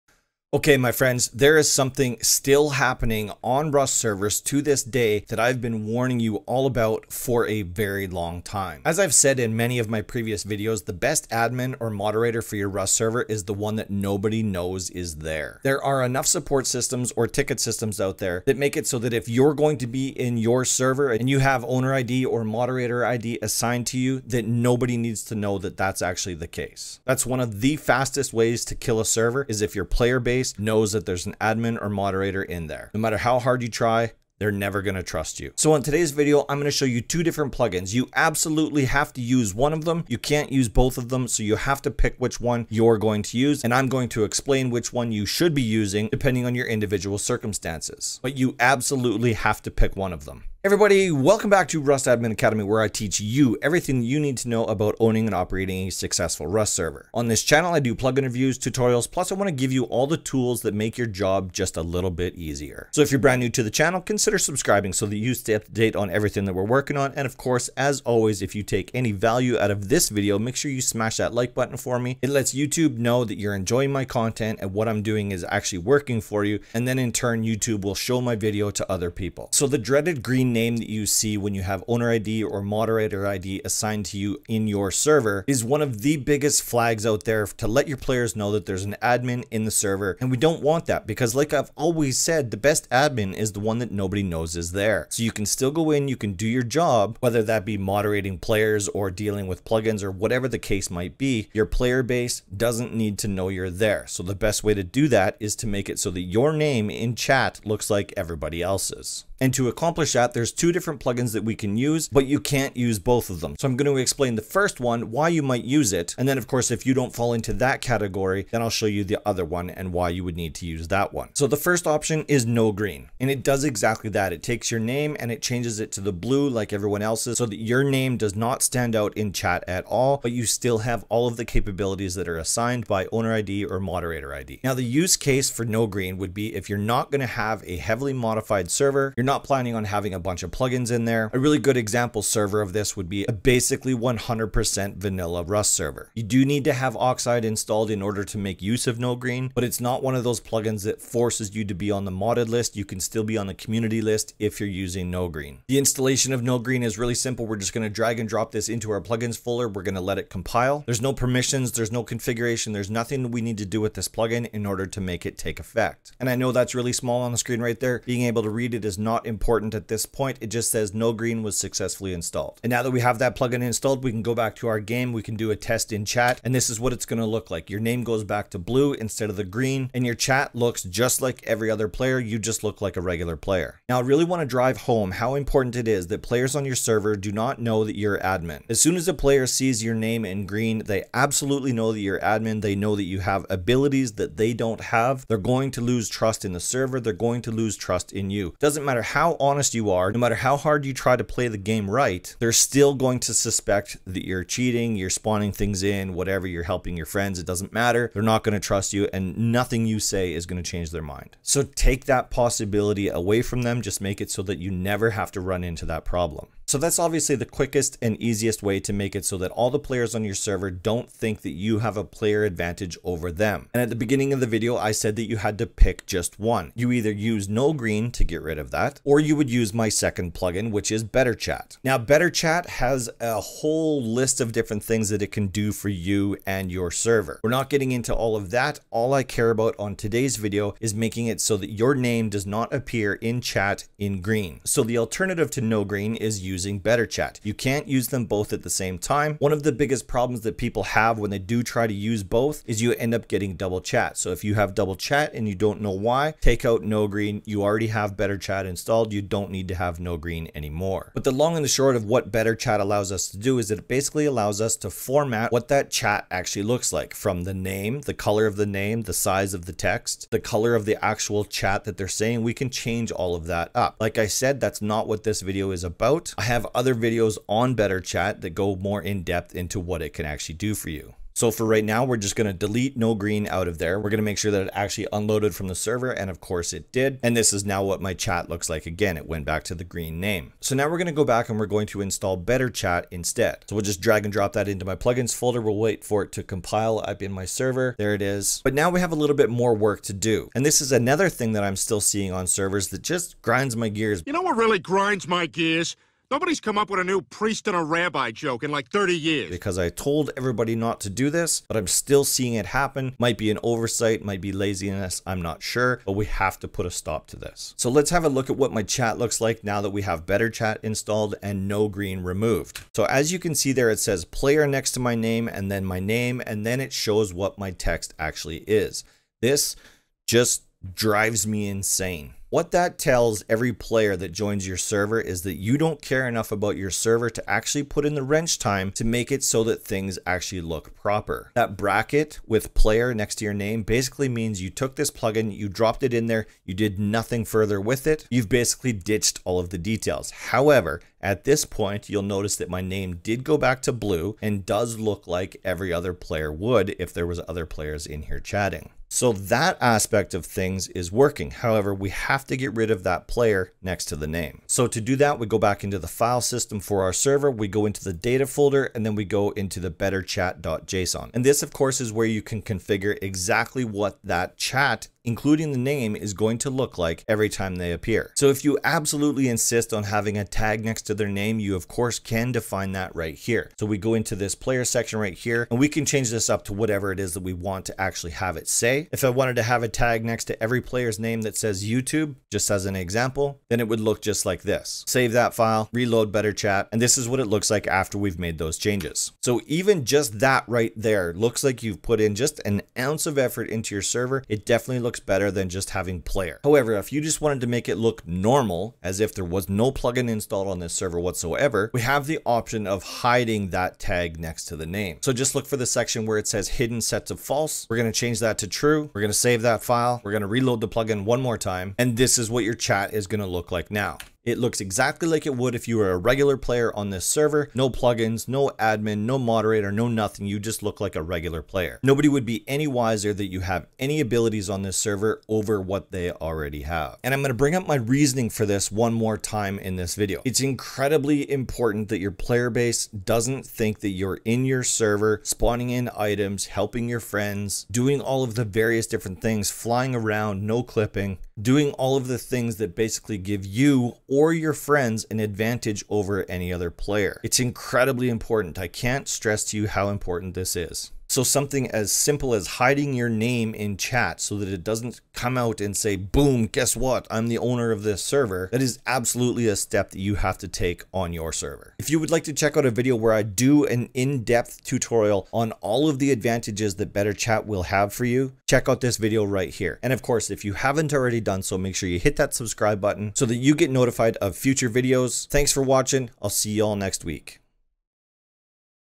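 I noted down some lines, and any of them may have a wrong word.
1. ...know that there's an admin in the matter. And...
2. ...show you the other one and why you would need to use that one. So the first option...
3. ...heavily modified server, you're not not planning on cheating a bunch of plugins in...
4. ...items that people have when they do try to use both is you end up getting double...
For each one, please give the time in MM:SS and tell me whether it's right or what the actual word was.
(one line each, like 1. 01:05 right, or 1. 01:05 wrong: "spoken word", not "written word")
1. 01:28 wrong: "server", not "matter"
2. 01:58 right
3. 02:17 wrong: "having", not "cheating"
4. 04:10 wrong: "problems", not "items".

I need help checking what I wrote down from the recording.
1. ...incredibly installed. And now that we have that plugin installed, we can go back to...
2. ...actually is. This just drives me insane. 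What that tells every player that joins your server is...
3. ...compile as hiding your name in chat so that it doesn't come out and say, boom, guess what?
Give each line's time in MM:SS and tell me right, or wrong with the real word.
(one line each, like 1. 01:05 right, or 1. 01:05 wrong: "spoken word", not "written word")
1. 02:51 wrong: "successfully", not "incredibly"
2. 05:28 right
3. 07:42 wrong: "simple", not "compile".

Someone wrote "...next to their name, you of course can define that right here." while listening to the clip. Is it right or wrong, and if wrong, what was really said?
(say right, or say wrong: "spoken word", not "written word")
right.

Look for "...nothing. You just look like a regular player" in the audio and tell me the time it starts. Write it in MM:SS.
07:10.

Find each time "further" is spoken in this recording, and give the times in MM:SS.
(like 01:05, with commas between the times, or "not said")
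05:47.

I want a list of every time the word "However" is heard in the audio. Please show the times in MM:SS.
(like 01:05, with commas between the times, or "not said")
05:50, 06:01, 06:46.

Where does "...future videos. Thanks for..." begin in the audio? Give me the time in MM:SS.
08:04.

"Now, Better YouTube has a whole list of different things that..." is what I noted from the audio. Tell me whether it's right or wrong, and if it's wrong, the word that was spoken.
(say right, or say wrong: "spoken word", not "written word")
wrong: "Chat", not "YouTube".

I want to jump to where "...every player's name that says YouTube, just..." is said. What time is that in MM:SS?
06:30.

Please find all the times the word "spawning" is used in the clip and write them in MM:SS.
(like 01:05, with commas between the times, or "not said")
03:25, 07:25.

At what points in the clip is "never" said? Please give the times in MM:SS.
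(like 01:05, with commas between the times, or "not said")
00:34, 03:34.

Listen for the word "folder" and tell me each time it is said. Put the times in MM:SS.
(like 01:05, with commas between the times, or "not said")
02:39, 04:55, 06:08.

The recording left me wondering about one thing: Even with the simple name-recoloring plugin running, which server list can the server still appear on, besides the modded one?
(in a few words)
community list.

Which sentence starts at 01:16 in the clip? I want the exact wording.
And then in turn, YouTube will show my video to other people.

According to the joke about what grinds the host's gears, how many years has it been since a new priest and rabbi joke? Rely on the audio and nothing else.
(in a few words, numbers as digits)
30.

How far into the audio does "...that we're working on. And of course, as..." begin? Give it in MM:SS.
01:06.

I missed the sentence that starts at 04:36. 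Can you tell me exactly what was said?
I have other videos on Better Chat that go more in depth into what it can actually do for you.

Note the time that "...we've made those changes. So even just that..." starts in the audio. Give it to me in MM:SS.
06:38.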